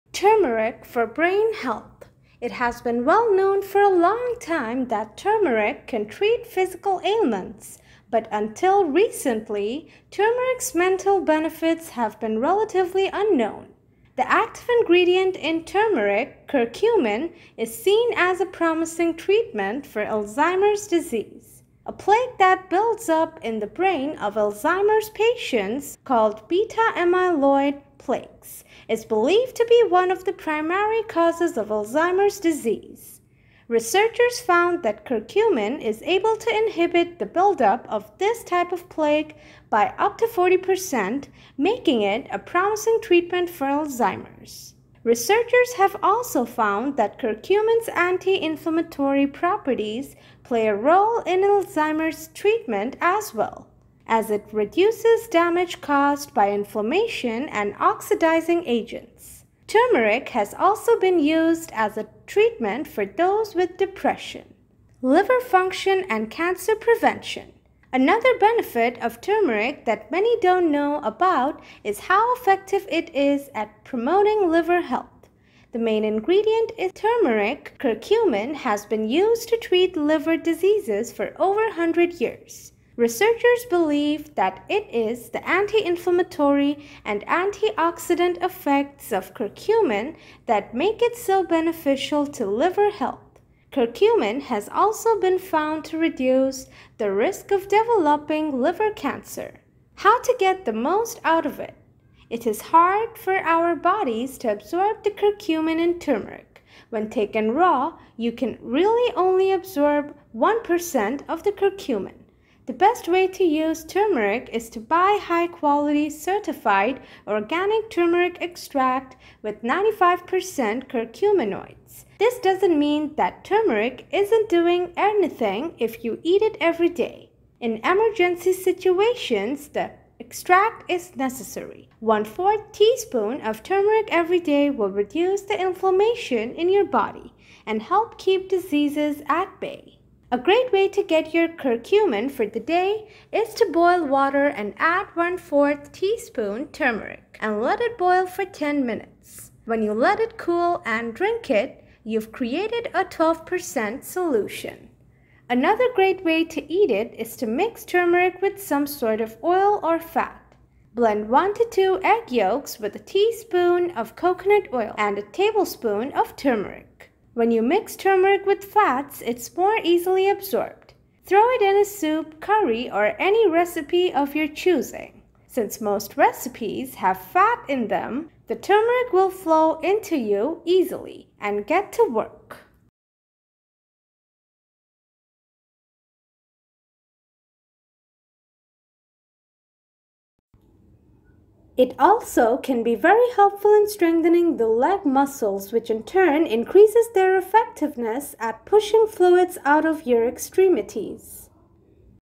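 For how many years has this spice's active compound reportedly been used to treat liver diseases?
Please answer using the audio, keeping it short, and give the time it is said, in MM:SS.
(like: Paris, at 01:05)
100 years, at 01:21.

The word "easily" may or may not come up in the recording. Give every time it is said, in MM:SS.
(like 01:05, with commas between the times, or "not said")
02:49, 03:00.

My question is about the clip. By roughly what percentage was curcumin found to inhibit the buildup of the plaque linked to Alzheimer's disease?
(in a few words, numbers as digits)
40%.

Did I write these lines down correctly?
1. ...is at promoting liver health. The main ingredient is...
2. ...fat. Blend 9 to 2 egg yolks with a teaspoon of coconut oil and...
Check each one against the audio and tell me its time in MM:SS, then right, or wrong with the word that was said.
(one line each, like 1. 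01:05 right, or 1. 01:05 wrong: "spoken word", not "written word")
1. 01:13 right
2. 02:39 wrong: "1", not "9".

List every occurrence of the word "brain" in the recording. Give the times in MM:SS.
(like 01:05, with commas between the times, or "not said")
00:01, 00:23.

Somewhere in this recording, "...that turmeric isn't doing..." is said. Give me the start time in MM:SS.
02:03.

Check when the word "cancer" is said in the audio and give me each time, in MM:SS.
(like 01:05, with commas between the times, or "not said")
01:06, 01:38.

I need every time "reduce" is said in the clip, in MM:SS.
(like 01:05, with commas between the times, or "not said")
00:54, 01:35, 02:14.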